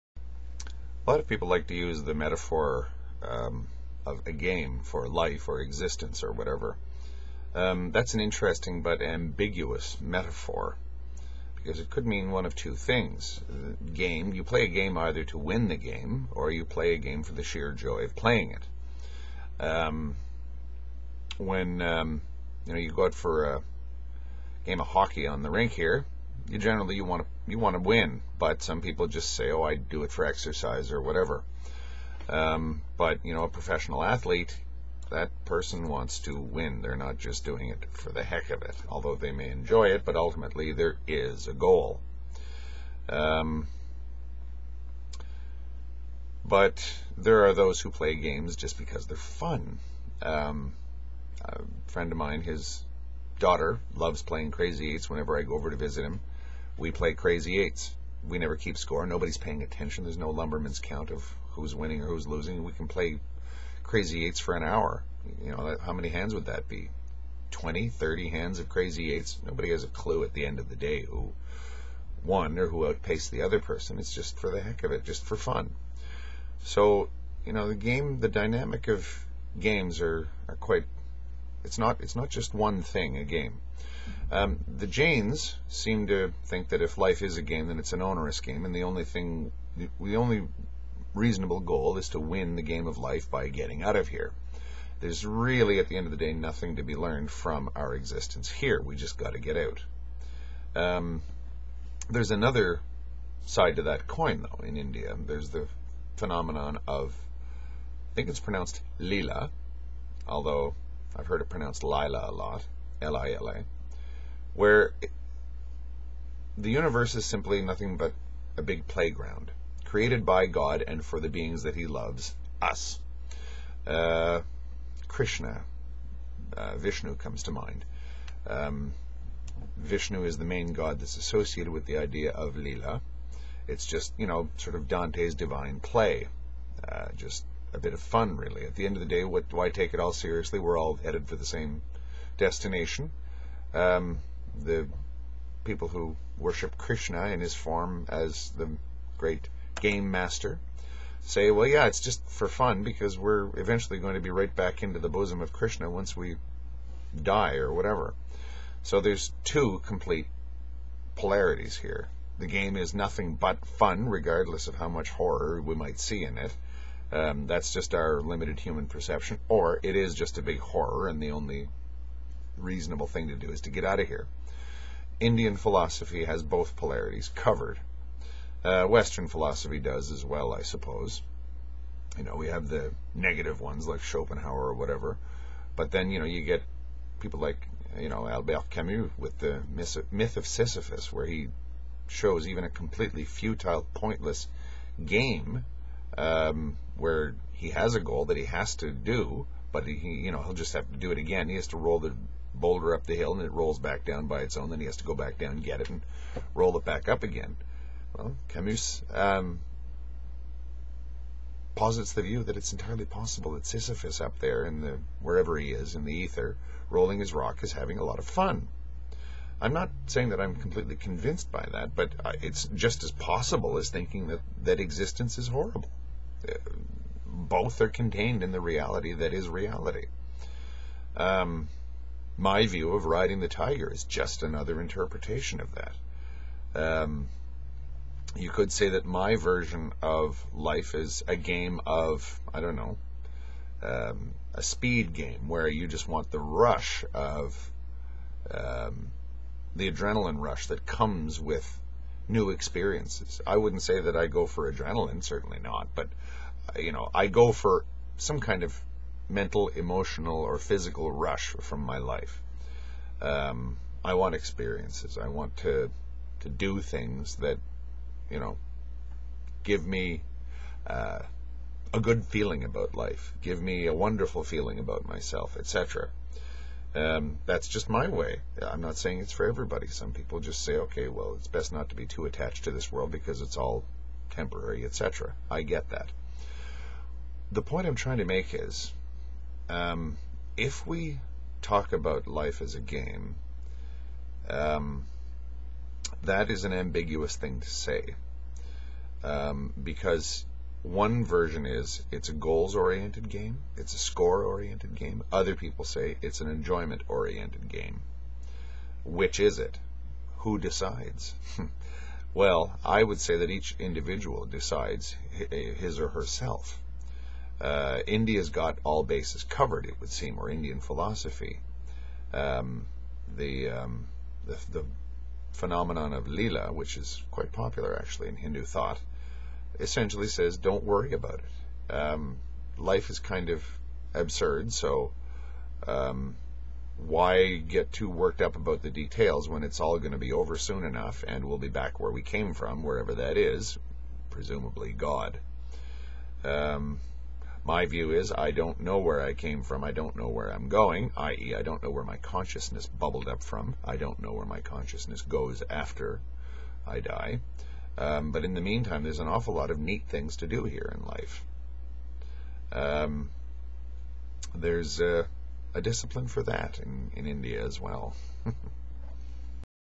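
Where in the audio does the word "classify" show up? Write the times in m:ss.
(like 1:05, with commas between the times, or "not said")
not said.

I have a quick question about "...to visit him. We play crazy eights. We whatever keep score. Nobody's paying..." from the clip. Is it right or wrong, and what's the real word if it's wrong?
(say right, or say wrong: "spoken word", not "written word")
wrong: "never", not "whatever".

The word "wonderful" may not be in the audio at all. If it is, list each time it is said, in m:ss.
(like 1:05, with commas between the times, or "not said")
4:33.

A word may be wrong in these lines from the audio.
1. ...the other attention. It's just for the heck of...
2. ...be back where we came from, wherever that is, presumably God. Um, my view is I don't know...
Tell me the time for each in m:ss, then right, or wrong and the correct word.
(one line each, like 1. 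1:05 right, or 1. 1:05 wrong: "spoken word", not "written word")
1. 1:13 wrong: "person", not "attention"
2. 5:41 right.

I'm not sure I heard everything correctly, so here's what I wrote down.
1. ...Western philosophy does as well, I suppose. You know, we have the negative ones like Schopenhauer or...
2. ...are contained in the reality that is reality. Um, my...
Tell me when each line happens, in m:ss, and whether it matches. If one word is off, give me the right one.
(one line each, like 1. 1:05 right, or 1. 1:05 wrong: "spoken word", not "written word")
1. 2:58 right
2. 3:47 right.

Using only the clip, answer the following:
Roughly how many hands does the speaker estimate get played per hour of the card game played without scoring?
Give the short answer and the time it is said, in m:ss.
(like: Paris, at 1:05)
20 to 30, at 1:07.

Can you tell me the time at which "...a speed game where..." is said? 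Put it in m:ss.
4:04.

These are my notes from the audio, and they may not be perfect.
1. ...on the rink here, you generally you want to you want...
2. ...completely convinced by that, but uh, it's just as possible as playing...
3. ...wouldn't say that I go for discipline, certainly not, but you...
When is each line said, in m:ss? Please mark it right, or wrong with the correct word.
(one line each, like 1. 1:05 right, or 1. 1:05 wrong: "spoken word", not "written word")
1. 0:25 right
2. 3:40 wrong: "thinking", not "playing"
3. 4:13 wrong: "adrenaline", not "discipline".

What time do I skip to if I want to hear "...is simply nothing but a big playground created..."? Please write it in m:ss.
1:57.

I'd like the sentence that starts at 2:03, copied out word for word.
Uh, Krishna, uh, Vishnu comes to mind.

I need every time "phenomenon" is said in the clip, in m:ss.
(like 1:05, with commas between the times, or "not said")
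1:46, 5:25.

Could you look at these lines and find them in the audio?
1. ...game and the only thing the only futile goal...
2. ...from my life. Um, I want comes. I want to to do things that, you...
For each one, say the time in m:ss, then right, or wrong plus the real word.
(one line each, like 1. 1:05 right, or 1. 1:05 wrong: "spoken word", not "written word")
1. 1:28 wrong: "reasonable", not "futile"
2. 4:21 wrong: "experiences", not "comes".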